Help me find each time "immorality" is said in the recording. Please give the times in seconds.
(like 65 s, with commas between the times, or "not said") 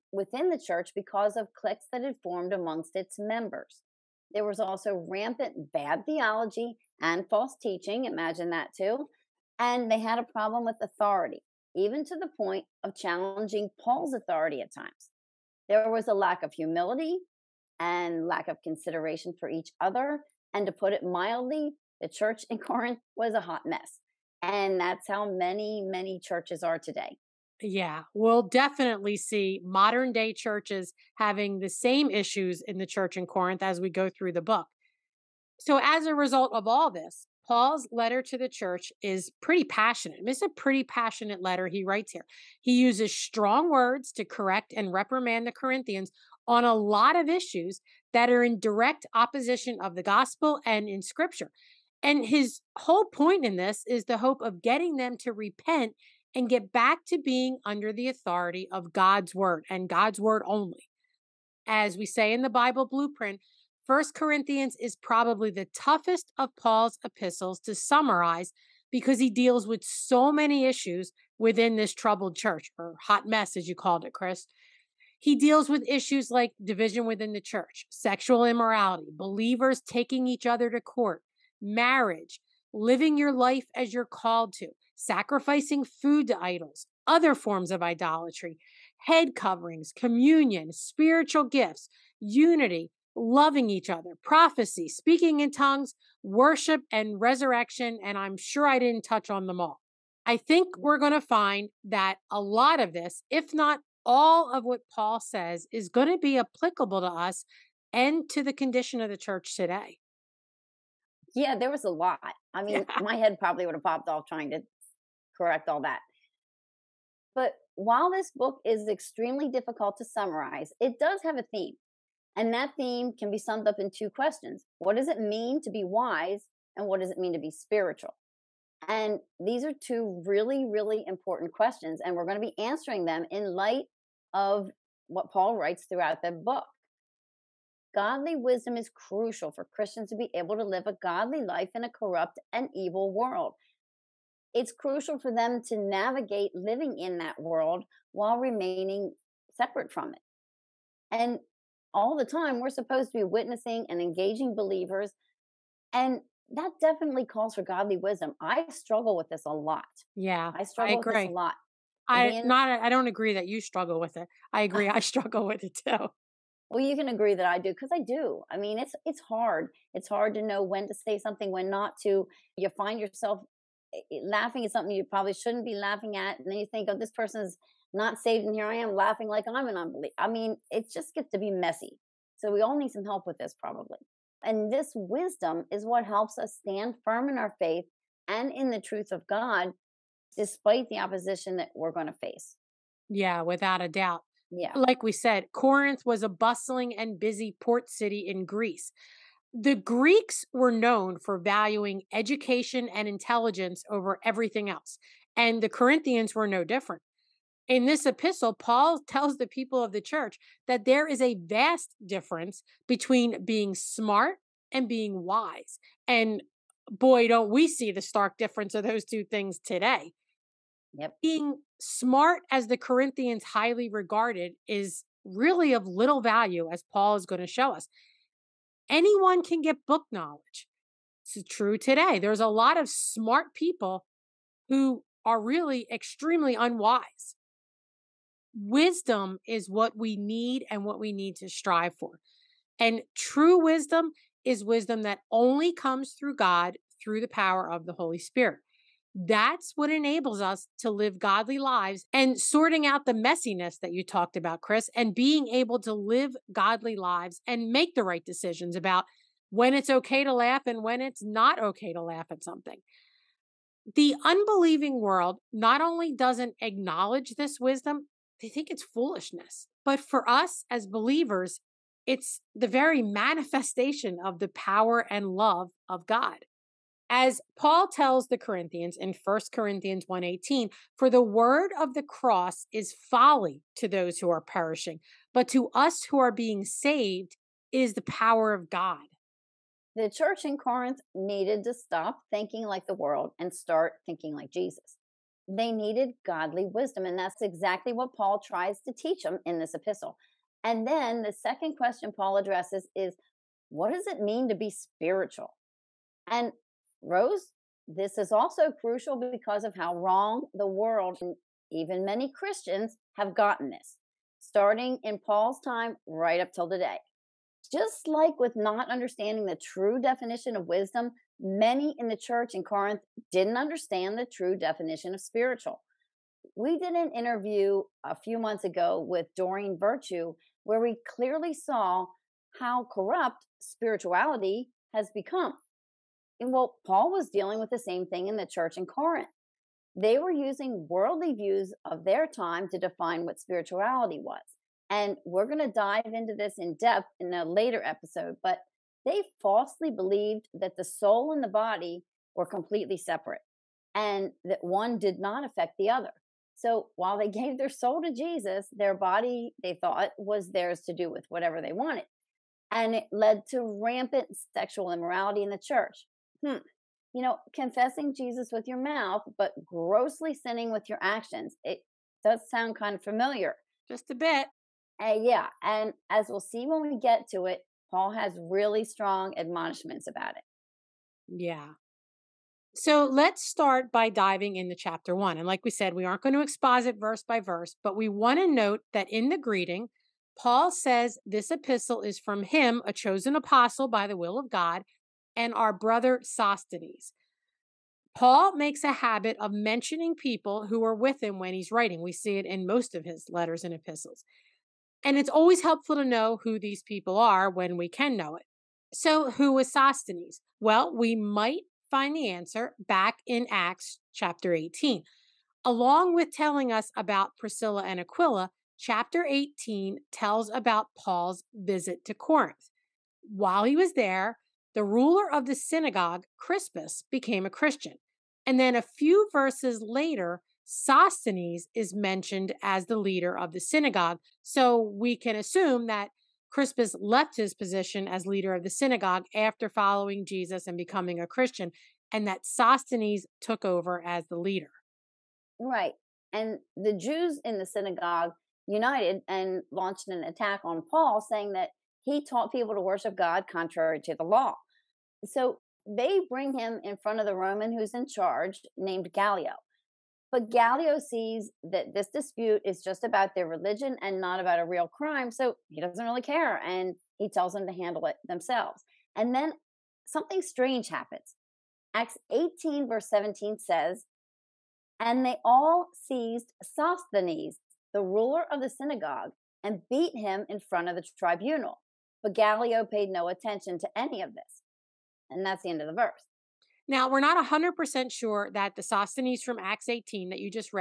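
78 s, 364 s.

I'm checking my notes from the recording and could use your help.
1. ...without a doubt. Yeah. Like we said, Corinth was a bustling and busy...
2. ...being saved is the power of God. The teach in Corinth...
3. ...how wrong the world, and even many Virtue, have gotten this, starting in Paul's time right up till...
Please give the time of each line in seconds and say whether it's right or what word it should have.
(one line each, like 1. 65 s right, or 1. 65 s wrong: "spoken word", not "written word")
1. 193 s right
2. 286 s wrong: "church", not "teach"
3. 309 s wrong: "Christians", not "Virtue".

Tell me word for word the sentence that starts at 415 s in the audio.
Along with telling us about Priscilla and Aquila, chapter 18 tells about Paul's visit to Corinth.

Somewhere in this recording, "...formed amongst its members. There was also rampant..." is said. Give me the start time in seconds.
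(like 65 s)
2 s.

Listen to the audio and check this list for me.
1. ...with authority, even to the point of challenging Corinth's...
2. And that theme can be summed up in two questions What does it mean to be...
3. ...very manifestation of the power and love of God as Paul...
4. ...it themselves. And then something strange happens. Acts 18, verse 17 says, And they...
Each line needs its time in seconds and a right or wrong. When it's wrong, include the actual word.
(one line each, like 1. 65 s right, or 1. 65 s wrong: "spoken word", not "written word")
1. 10 s wrong: "Paul", not "Corinth"
2. 122 s right
3. 272 s right
4. 468 s right.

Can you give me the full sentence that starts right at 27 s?
Yeah, we'll definitely see modern day churches having the same issues in the church in Corinth as we go through the book.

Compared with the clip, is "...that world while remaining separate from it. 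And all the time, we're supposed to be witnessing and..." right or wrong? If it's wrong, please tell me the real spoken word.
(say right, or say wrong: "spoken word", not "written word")
right.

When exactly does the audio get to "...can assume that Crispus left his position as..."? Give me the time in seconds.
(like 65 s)
435 s.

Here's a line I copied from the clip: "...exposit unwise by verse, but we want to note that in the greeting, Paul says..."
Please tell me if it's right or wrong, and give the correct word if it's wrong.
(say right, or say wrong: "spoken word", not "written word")
wrong: "verse", not "unwise".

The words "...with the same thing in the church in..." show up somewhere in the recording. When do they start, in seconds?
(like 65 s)
337 s.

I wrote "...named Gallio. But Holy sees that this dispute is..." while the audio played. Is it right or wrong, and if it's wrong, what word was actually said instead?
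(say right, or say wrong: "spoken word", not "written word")
wrong: "Gallio", not "Holy".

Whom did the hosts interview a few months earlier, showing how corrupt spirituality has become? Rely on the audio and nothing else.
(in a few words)
Doreen Virtue.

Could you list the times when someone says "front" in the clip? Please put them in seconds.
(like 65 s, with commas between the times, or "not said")
456 s, 480 s.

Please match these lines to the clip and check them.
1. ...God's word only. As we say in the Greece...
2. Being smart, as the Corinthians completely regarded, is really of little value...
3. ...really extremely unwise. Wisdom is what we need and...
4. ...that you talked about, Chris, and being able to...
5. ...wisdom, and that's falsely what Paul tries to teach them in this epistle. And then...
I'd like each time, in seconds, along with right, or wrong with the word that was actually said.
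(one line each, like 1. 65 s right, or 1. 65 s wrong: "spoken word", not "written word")
1. 59 s wrong: "Bible", not "Greece"
2. 221 s wrong: "highly", not "completely"
3. 235 s right
4. 253 s right
5. 296 s wrong: "exactly", not "falsely".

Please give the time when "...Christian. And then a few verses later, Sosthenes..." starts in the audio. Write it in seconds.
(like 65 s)
427 s.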